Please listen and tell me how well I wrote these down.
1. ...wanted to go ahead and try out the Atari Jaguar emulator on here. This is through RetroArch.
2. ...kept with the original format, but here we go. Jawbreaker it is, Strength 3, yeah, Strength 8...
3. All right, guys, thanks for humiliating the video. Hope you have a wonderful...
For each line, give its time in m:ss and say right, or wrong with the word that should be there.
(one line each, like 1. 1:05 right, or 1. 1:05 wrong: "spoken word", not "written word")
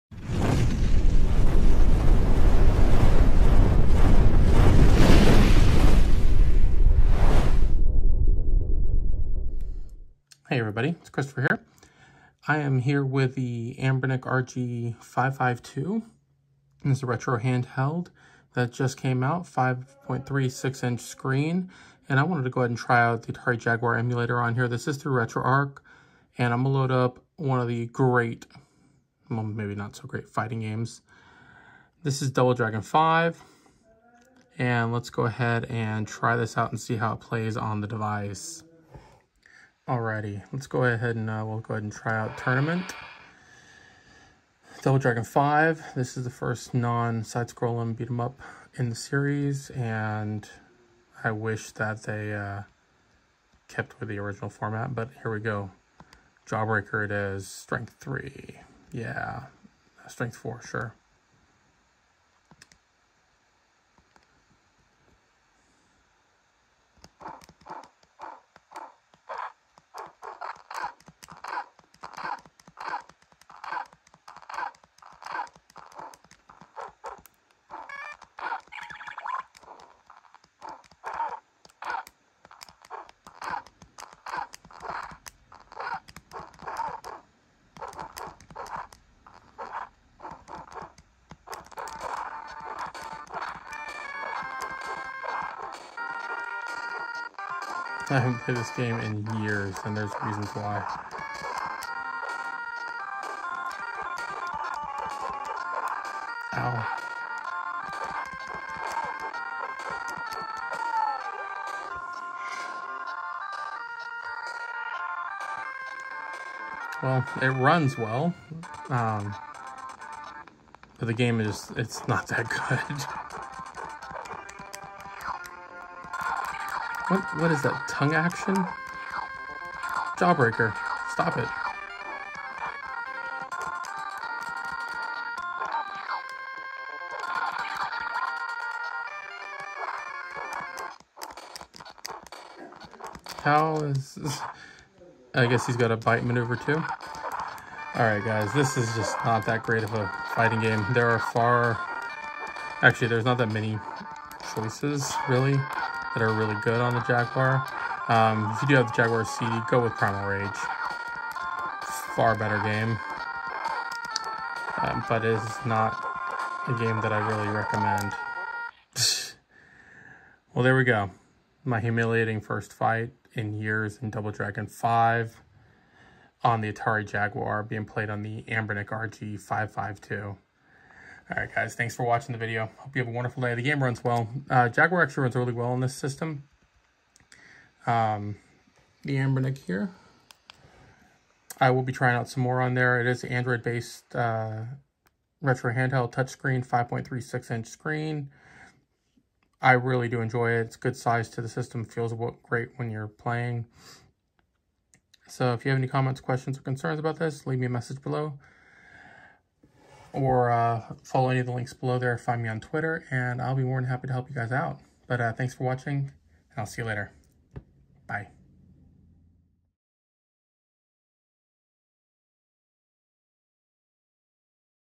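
1. 0:22 right
2. 0:53 wrong: "4", not "8"
3. 3:01 wrong: "watching", not "humiliating".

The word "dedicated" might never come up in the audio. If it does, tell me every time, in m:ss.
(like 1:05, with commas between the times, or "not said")
not said.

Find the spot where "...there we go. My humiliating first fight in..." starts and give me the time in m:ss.
2:50.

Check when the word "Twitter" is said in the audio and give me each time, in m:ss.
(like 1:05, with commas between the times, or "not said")
3:32.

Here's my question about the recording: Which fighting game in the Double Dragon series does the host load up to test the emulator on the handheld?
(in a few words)
Double Dragon 5.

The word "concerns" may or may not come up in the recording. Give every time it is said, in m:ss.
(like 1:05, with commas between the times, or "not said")
3:26.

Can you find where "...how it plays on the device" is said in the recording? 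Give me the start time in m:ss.
0:36.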